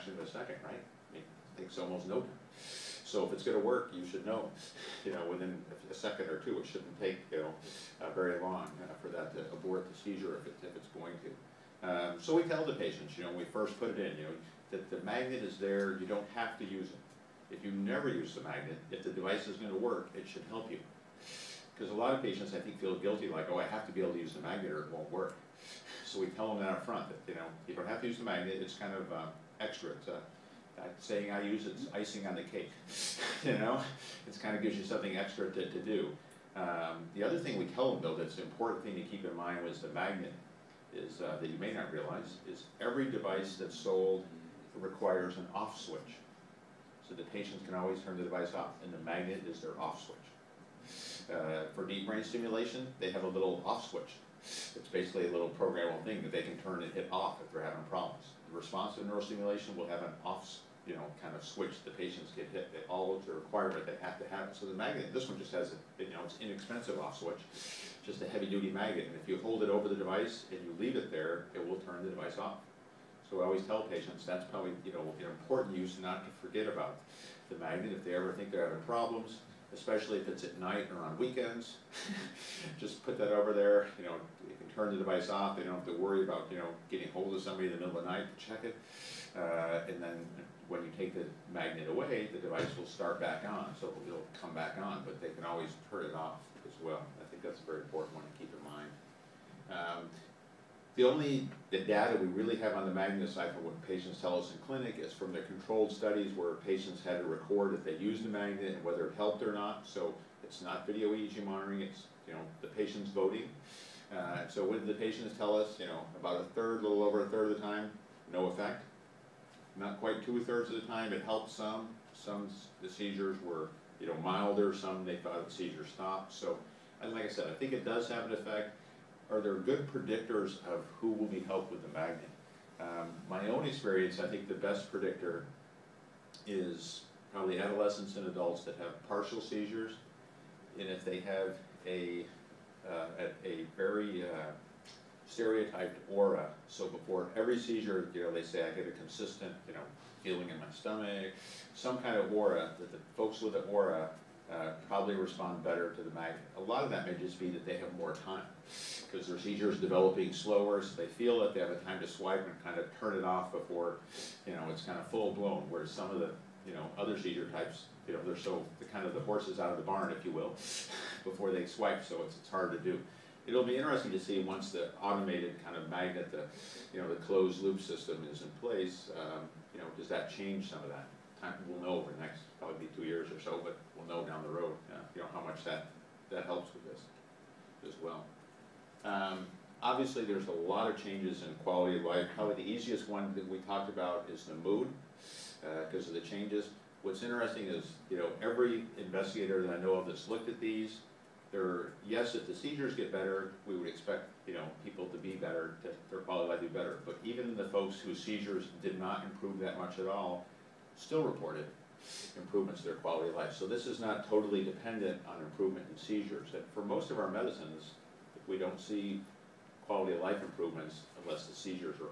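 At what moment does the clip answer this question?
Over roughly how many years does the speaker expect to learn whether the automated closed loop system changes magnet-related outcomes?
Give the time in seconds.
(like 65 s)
182 s.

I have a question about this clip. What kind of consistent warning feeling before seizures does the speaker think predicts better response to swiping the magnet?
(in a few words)
stereotyped aura.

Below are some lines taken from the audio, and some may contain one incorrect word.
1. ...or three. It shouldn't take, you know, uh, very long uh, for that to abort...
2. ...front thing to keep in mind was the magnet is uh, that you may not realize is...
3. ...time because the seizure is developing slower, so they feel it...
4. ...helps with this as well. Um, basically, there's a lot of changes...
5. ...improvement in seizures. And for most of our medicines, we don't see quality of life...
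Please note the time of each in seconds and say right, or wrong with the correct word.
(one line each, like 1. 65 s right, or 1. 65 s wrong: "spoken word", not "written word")
1. 6 s wrong: "two", not "three"
2. 38 s wrong: "important", not "front"
3. 158 s right
4. 186 s wrong: "obviously", not "basically"
5. 215 s right.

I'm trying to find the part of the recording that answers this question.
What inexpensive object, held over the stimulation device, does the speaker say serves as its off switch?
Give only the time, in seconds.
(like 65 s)
68 s.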